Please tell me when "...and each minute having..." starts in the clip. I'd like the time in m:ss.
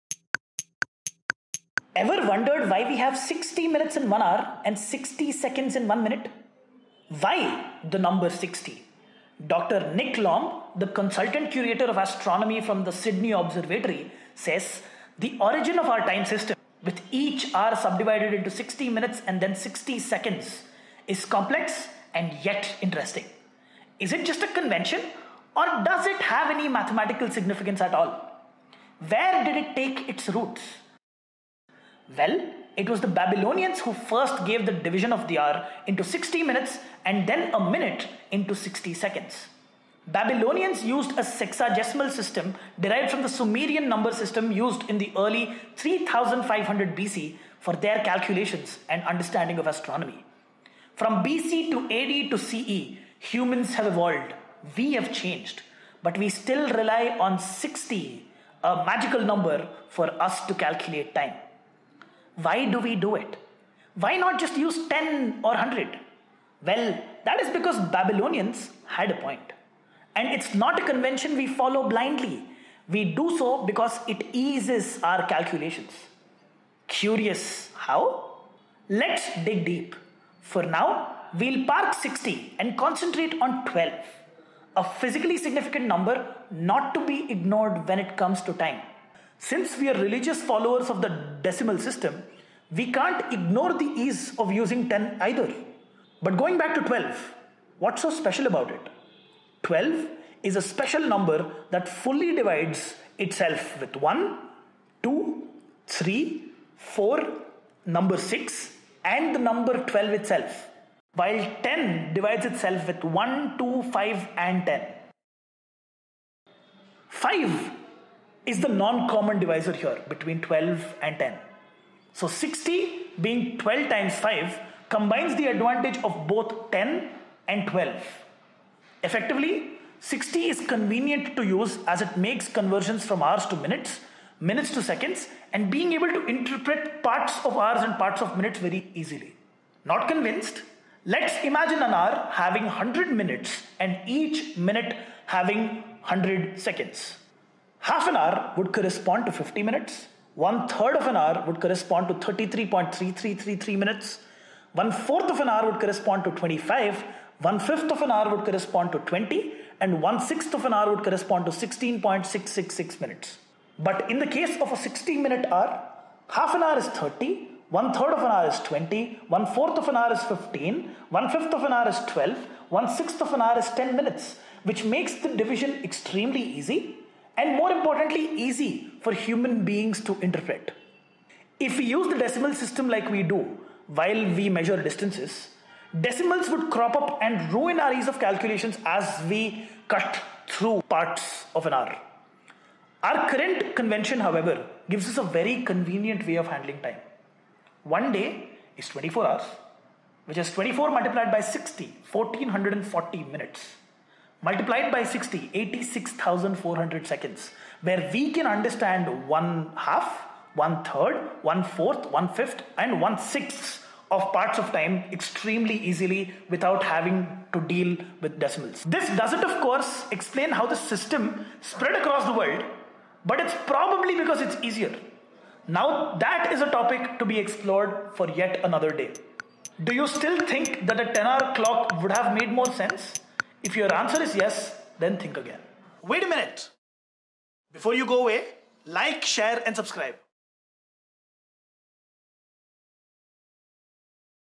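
2:23.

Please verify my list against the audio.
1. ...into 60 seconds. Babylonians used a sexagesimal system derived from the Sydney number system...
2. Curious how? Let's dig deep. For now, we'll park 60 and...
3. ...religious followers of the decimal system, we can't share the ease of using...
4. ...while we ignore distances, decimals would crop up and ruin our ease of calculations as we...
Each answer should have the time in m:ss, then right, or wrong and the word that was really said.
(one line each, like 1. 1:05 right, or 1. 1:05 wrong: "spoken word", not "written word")
1. 0:38 wrong: "Sumerian", not "Sydney"
2. 1:16 right
3. 1:29 wrong: "ignore", not "share"
4. 3:03 wrong: "measure", not "ignore".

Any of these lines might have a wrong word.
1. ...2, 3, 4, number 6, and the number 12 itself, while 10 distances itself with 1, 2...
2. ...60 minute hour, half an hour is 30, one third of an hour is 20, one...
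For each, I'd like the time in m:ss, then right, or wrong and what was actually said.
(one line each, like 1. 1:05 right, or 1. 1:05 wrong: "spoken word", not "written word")
1. 1:45 wrong: "divides", not "distances"
2. 2:44 right.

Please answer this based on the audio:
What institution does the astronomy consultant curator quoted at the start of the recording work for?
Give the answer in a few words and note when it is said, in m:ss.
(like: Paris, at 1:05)
Sydney Observatory, at 0:12.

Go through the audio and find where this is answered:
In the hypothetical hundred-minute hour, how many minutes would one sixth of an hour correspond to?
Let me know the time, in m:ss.
2:41.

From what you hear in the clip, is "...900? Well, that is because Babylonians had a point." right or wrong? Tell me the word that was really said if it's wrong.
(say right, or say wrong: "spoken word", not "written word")
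wrong: "100", not "900".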